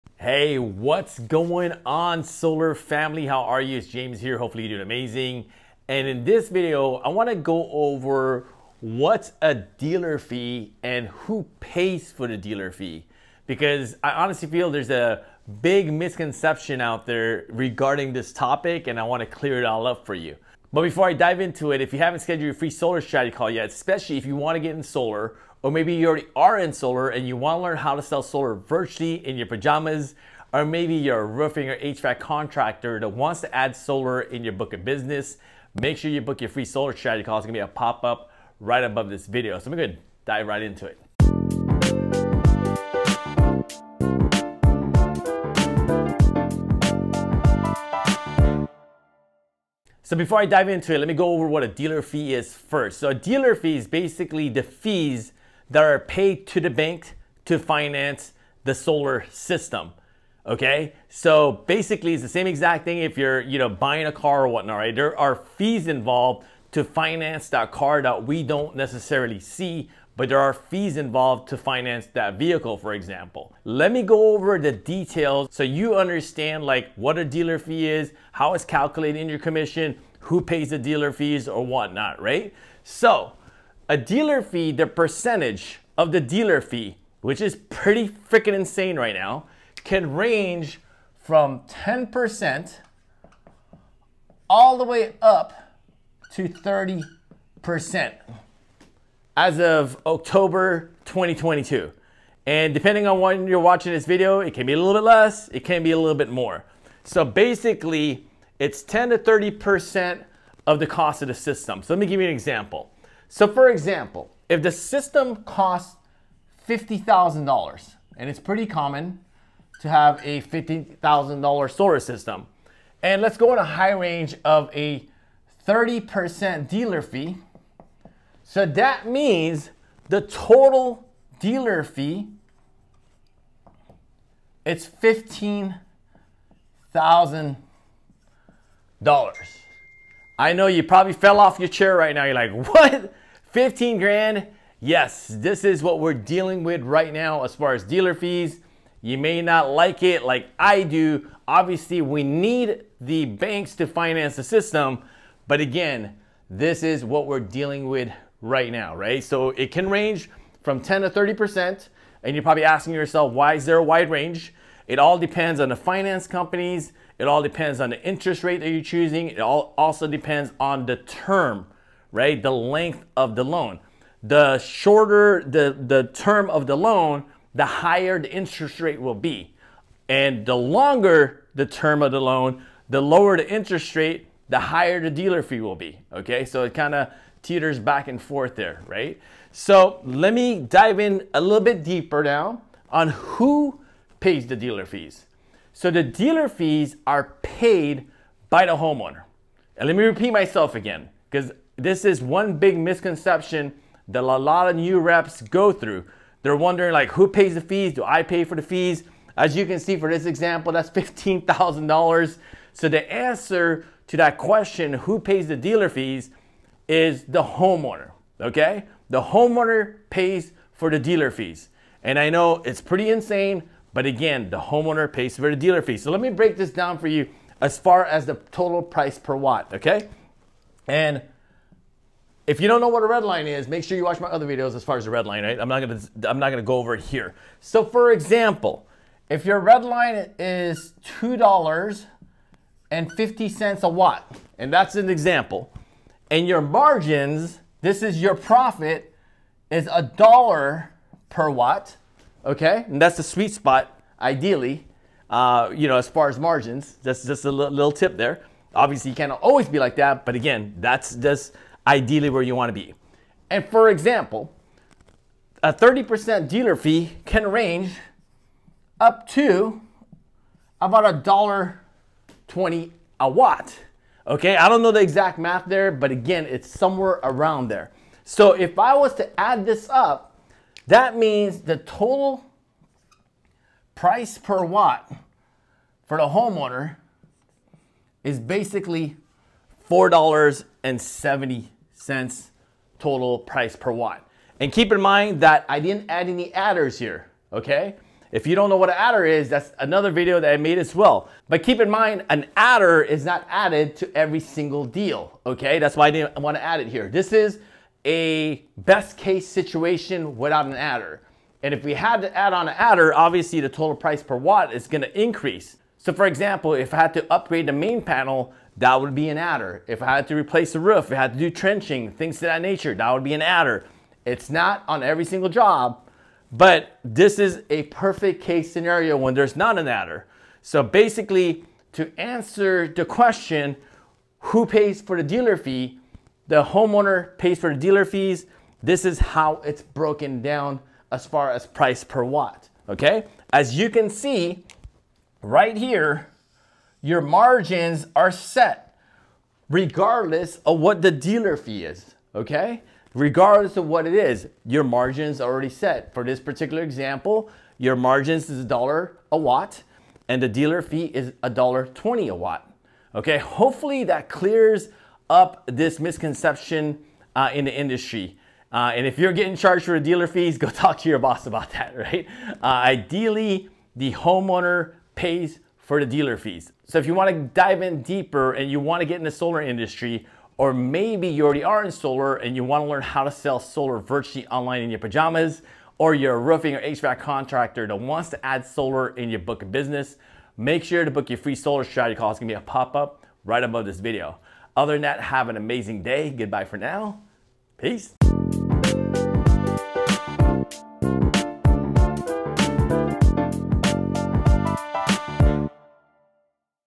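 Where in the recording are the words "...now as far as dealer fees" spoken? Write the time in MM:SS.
02:27.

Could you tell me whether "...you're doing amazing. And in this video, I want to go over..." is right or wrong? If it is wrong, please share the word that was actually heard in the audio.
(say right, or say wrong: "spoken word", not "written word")
right.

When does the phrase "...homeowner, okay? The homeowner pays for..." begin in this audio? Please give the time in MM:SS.
03:37.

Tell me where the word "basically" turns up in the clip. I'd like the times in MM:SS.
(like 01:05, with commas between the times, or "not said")
00:53, 01:01, 01:47, 04:48, 05:30.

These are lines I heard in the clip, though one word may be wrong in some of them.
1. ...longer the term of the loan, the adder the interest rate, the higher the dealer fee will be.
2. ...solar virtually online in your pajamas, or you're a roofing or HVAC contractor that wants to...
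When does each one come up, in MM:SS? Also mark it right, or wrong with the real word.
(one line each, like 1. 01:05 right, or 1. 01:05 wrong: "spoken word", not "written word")
1. 03:00 wrong: "lower", not "adder"
2. 06:23 right.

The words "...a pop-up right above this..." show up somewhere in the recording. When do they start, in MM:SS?
06:32.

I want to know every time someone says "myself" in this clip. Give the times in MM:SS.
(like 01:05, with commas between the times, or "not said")
03:20.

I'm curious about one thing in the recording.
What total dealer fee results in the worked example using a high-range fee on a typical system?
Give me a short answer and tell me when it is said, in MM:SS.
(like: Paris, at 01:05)
$15,000, at 02:14.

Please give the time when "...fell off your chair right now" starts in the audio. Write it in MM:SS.
02:21.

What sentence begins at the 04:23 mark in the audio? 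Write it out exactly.
And for example, a 30% dealer fee can range up to about a dollar 20 a watt.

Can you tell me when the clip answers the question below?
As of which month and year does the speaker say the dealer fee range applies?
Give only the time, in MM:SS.
01:40.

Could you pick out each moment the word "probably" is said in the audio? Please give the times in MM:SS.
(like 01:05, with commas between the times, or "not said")
02:20, 02:42.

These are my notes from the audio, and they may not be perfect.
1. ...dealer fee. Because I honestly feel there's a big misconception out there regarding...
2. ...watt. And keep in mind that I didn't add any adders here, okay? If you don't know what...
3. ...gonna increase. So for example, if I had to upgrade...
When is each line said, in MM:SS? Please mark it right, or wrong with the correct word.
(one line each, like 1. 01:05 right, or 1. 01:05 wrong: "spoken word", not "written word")
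1. 00:12 right
2. 04:53 right
3. 05:14 right.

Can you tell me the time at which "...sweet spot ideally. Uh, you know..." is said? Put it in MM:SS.
04:13.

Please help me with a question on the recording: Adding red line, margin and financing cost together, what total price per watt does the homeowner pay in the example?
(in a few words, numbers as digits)
$4.70.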